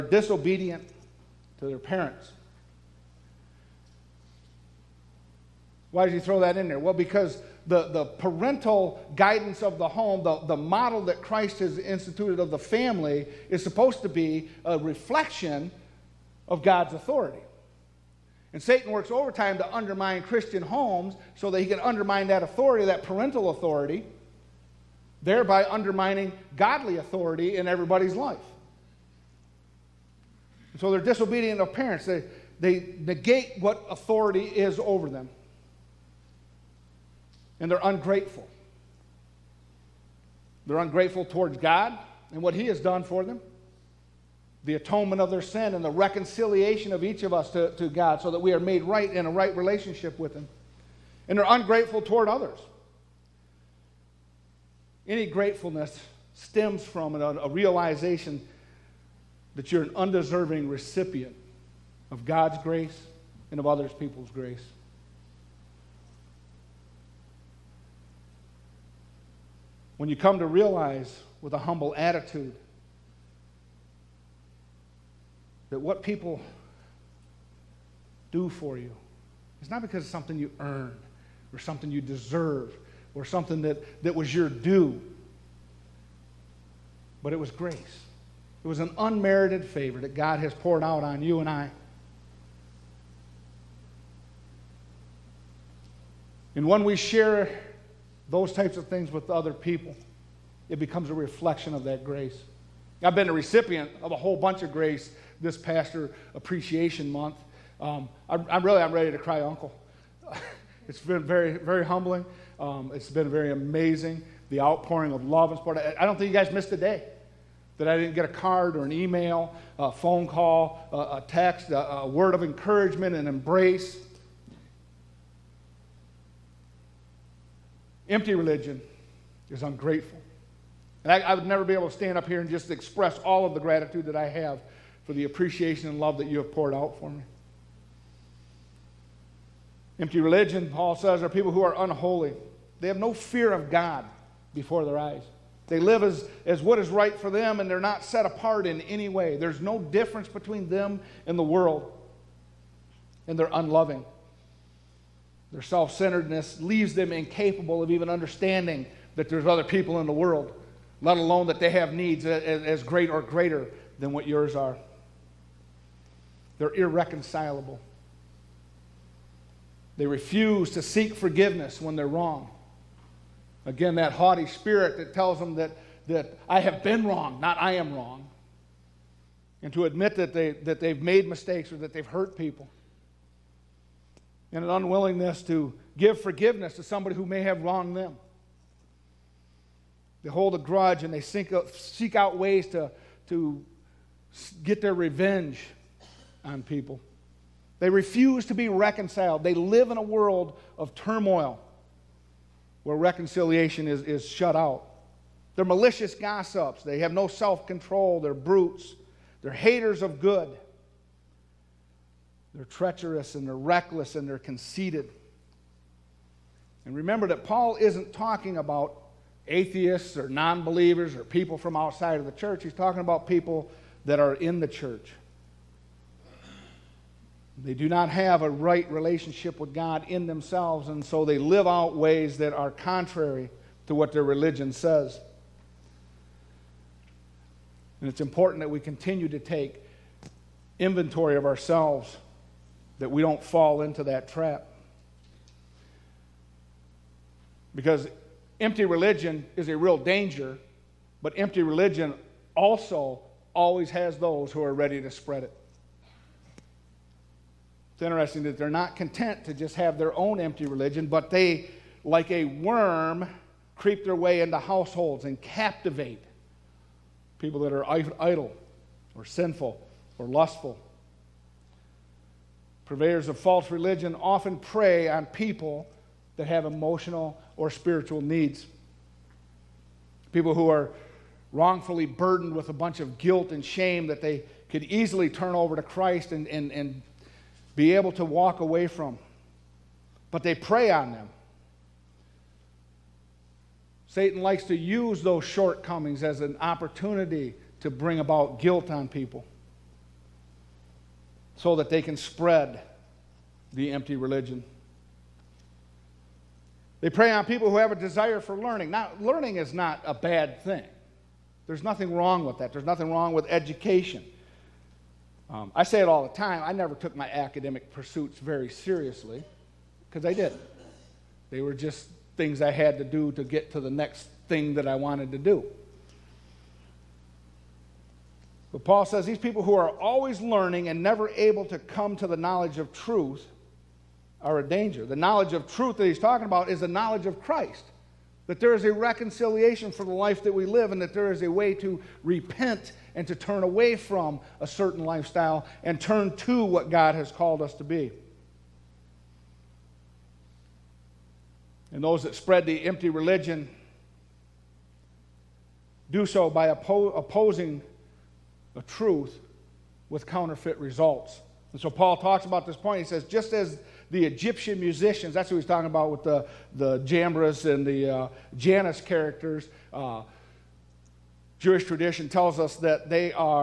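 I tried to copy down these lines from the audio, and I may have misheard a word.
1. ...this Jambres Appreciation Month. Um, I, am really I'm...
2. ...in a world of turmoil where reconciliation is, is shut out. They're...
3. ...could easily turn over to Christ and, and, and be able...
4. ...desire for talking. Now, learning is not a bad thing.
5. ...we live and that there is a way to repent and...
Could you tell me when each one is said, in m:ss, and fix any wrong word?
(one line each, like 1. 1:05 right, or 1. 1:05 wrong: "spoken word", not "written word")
1. 1:45 wrong: "Pastor", not "Jambres"
2. 3:19 right
3. 4:44 right
4. 5:07 wrong: "learning", not "talking"
5. 5:40 right.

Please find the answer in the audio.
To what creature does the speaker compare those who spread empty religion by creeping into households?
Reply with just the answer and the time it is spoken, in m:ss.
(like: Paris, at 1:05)
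a worm, at 4:22.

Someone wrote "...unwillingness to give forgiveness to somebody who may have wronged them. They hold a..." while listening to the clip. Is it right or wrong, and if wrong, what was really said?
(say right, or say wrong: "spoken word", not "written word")
right.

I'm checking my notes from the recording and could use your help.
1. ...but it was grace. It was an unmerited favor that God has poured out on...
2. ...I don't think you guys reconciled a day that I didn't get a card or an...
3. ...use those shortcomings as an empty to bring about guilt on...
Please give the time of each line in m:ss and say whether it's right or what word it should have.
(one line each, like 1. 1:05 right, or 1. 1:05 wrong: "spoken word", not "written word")
1. 1:27 right
2. 1:56 wrong: "missed", not "reconciled"
3. 4:54 wrong: "opportunity", not "empty".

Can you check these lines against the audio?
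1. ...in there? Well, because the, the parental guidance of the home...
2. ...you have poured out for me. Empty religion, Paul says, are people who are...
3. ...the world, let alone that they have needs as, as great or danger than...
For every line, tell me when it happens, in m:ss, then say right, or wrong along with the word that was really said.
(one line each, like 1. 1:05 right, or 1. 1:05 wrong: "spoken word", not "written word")
1. 0:06 right
2. 2:16 right
3. 2:40 wrong: "greater", not "danger".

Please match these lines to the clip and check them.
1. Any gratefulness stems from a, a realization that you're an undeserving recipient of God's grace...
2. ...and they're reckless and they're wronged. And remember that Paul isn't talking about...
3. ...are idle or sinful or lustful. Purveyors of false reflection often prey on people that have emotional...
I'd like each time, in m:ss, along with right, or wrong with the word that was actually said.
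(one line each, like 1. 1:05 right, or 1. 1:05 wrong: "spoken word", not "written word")
1. 0:55 right
2. 3:33 wrong: "conceited", not "wronged"
3. 4:27 wrong: "religion", not "reflection".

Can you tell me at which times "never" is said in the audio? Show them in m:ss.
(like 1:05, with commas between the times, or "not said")
2:11, 5:16, 5:31.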